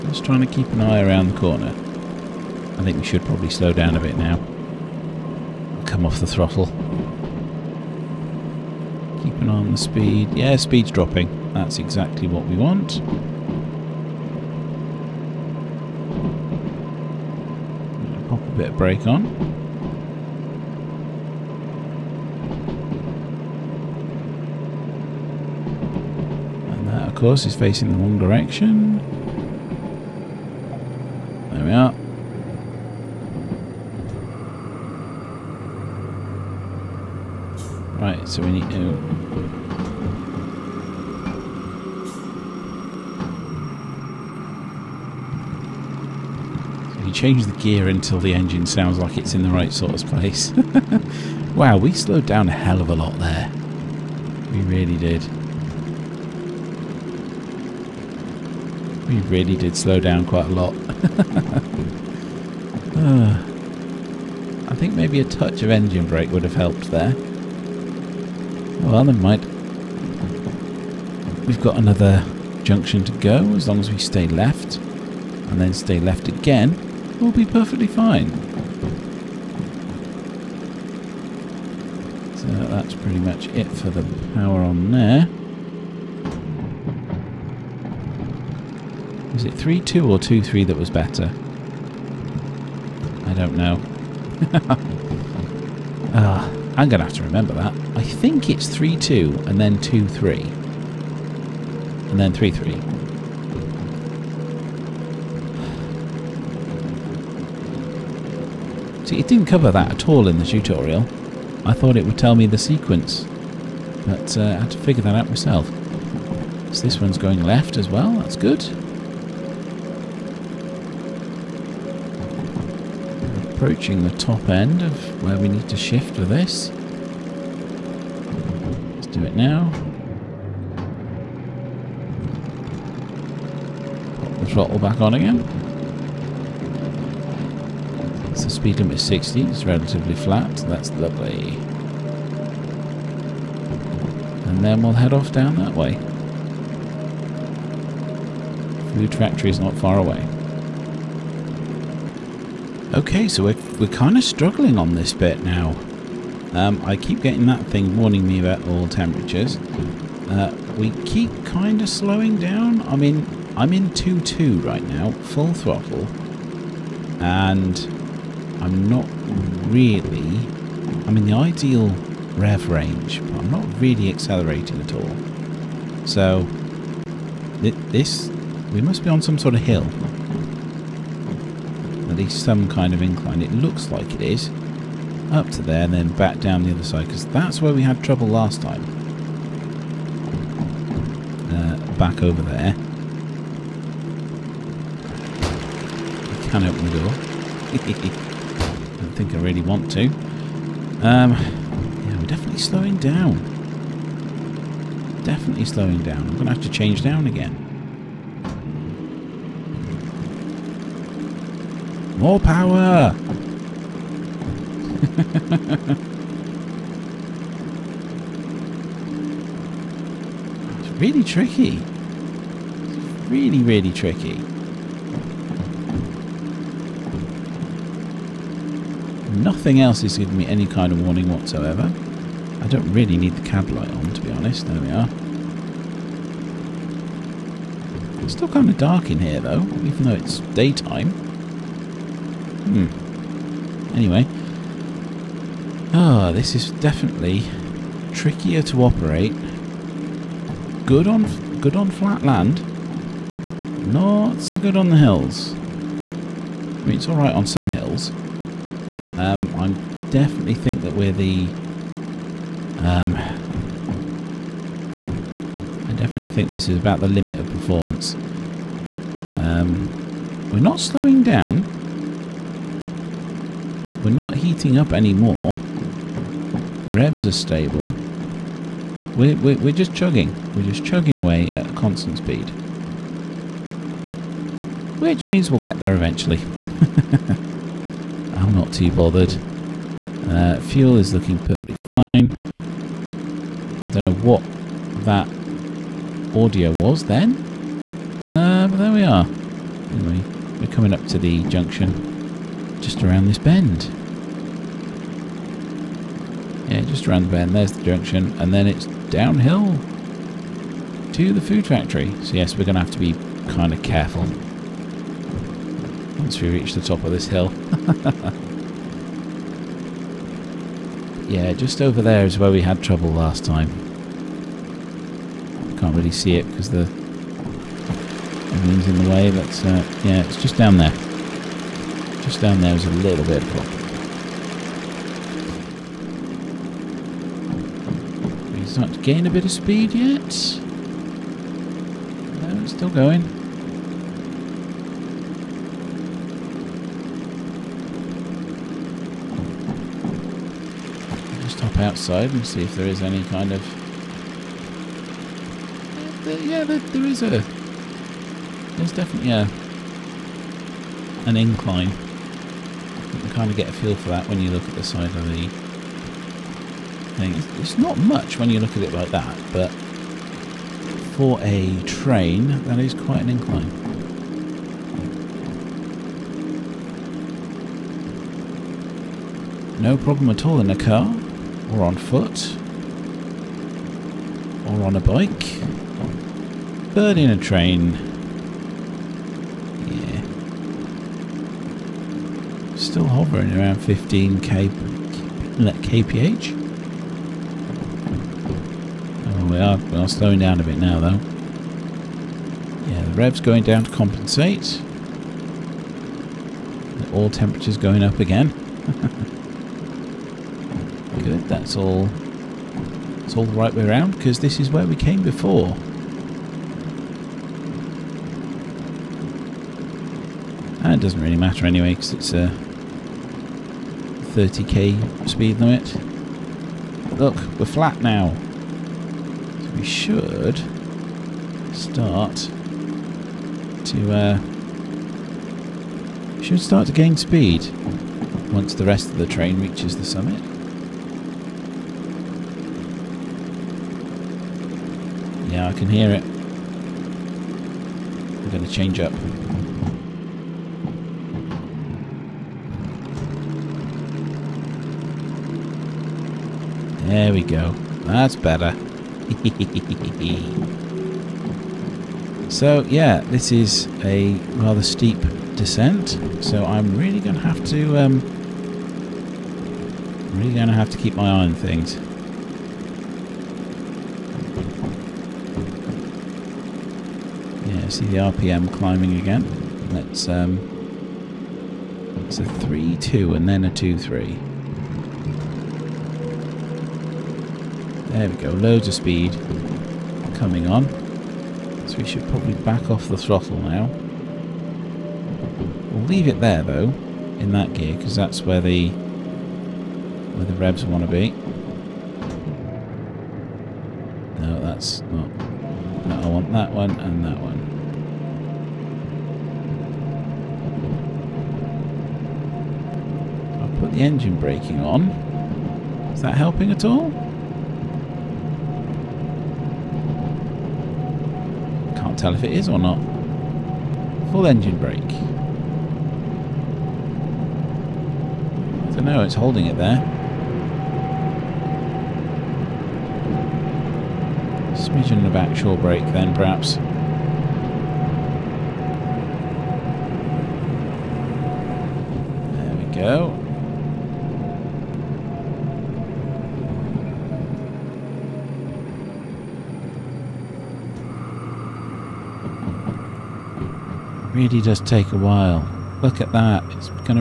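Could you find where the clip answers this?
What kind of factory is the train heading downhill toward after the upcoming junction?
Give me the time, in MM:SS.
05:11.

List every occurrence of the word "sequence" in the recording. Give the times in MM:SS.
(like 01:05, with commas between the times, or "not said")
01:52.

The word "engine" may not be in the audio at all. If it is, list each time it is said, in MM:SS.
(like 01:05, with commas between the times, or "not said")
00:48, 01:05, 08:34, 08:44.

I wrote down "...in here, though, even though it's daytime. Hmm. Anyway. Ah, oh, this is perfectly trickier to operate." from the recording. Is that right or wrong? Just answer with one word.
wrong.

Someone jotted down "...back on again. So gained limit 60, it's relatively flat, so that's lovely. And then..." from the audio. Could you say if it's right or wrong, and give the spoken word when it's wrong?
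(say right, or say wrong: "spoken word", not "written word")
wrong: "speed", not "gained".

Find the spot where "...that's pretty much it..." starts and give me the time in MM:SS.
01:22.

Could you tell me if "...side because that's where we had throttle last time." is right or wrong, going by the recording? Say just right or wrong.
wrong.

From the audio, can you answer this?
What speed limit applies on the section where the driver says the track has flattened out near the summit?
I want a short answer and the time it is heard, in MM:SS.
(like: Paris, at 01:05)
30 kph, at 07:04.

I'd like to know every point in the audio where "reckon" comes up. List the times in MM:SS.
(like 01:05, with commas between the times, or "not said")
not said.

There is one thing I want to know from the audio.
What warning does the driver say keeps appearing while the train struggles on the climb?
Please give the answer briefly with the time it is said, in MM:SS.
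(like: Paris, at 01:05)
temperatures, at 02:38.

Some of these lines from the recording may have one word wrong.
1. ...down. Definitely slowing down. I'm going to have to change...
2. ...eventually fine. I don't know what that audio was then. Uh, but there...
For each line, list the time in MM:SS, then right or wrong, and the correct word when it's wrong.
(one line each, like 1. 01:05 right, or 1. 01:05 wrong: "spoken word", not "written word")
1. 03:22 right
2. 04:51 wrong: "perfectly", not "eventually".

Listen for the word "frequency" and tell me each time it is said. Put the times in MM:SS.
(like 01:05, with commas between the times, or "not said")
not said.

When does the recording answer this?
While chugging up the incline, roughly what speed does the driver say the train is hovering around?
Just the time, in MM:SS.
06:33.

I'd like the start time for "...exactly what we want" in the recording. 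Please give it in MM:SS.
00:11.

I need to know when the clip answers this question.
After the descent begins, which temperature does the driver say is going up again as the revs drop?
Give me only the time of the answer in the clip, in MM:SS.
06:47.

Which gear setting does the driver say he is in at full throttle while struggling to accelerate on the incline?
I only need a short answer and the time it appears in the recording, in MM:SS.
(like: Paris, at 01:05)
2-2, at 02:43.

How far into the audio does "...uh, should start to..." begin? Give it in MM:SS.
07:14.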